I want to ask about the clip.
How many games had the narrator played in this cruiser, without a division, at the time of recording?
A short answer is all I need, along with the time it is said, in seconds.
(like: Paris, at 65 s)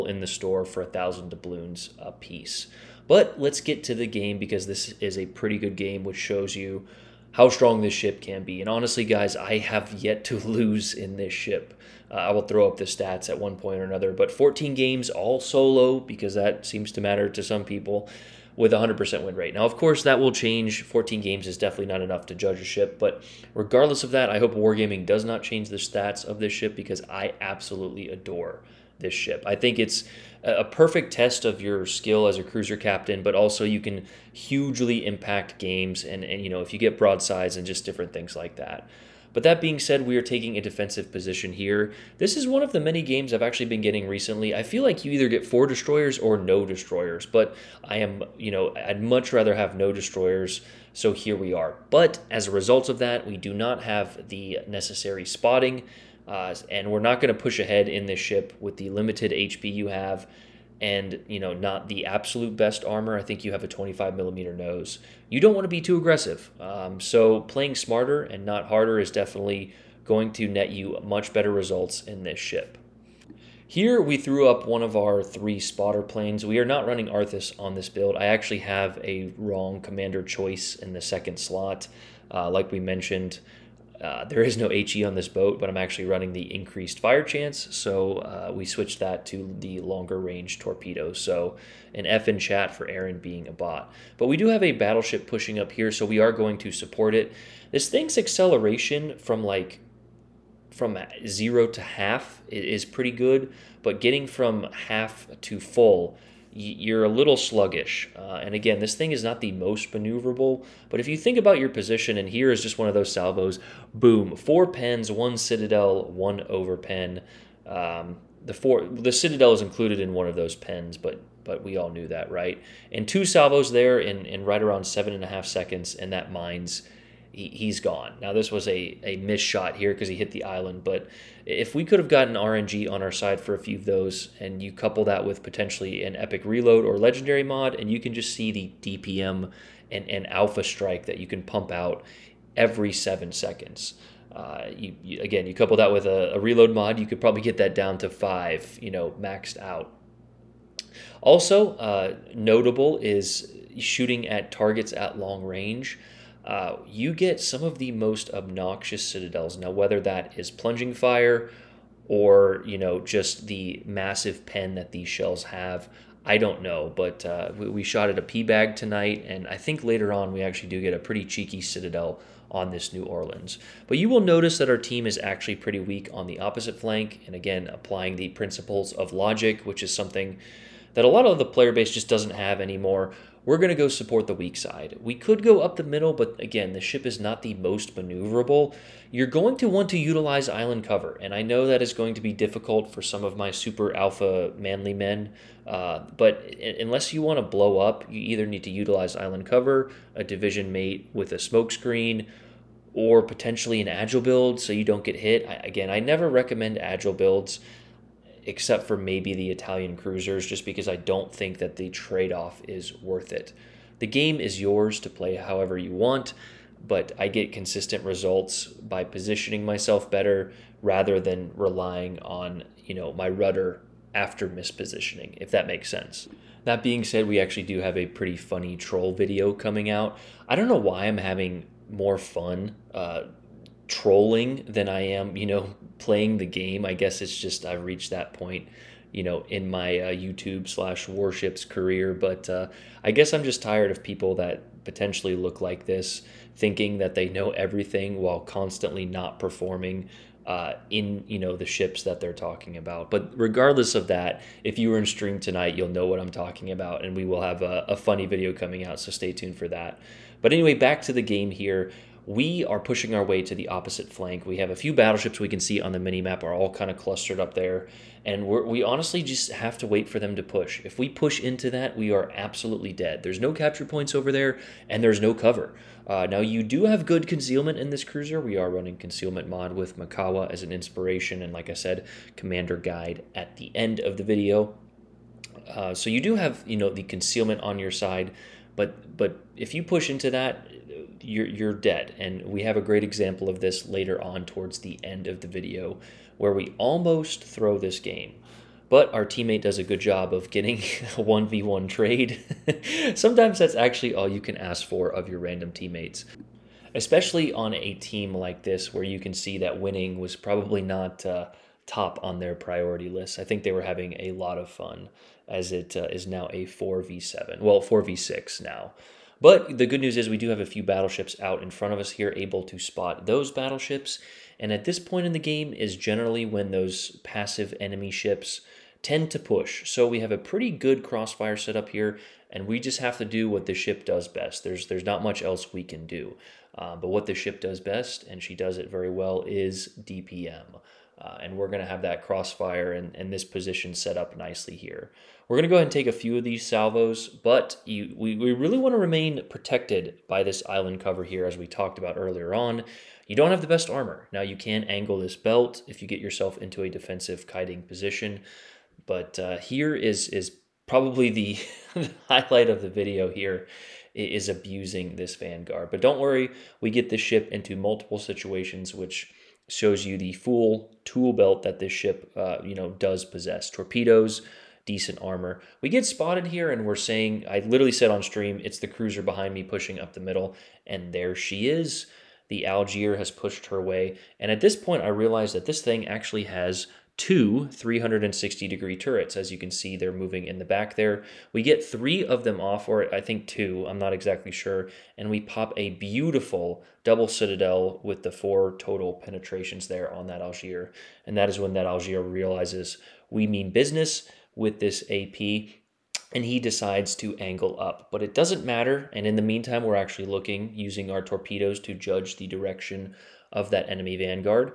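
14, at 14 s.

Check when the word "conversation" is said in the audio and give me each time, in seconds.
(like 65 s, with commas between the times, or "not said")
not said.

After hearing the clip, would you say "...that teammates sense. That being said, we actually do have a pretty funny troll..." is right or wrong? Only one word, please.
wrong.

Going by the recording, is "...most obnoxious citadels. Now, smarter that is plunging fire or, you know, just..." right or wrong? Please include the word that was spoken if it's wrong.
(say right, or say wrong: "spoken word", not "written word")
wrong: "whether", not "smarter".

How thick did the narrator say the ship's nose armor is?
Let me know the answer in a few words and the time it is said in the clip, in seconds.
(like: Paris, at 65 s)
25 millimeter, at 63 s.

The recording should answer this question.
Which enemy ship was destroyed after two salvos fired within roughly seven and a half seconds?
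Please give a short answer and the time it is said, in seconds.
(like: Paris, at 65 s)
Mainz, at 126 s.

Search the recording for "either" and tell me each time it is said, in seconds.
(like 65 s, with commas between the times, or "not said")
45 s, 198 s.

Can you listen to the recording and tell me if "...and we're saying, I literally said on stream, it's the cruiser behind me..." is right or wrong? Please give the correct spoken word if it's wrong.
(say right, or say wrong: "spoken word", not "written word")
right.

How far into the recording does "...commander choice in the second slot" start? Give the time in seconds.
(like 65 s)
79 s.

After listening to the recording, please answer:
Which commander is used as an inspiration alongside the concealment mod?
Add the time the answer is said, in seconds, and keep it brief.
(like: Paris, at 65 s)
Mikawa, at 279 s.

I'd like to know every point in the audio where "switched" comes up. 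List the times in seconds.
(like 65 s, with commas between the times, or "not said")
88 s.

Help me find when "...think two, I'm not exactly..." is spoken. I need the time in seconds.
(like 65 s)
393 s.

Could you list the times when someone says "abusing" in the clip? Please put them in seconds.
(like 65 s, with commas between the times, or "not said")
364 s.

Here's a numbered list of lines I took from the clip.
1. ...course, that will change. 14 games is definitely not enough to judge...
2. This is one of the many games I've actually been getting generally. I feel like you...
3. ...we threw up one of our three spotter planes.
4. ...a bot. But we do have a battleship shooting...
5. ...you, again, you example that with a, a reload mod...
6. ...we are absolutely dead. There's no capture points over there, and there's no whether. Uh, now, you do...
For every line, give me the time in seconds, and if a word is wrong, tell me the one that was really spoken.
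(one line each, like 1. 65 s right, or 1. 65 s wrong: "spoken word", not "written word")
1. 19 s right
2. 42 s wrong: "recently", not "generally"
3. 74 s right
4. 93 s wrong: "pushing", not "shooting"
5. 145 s wrong: "couple", not "example"
6. 271 s wrong: "cover", not "whether".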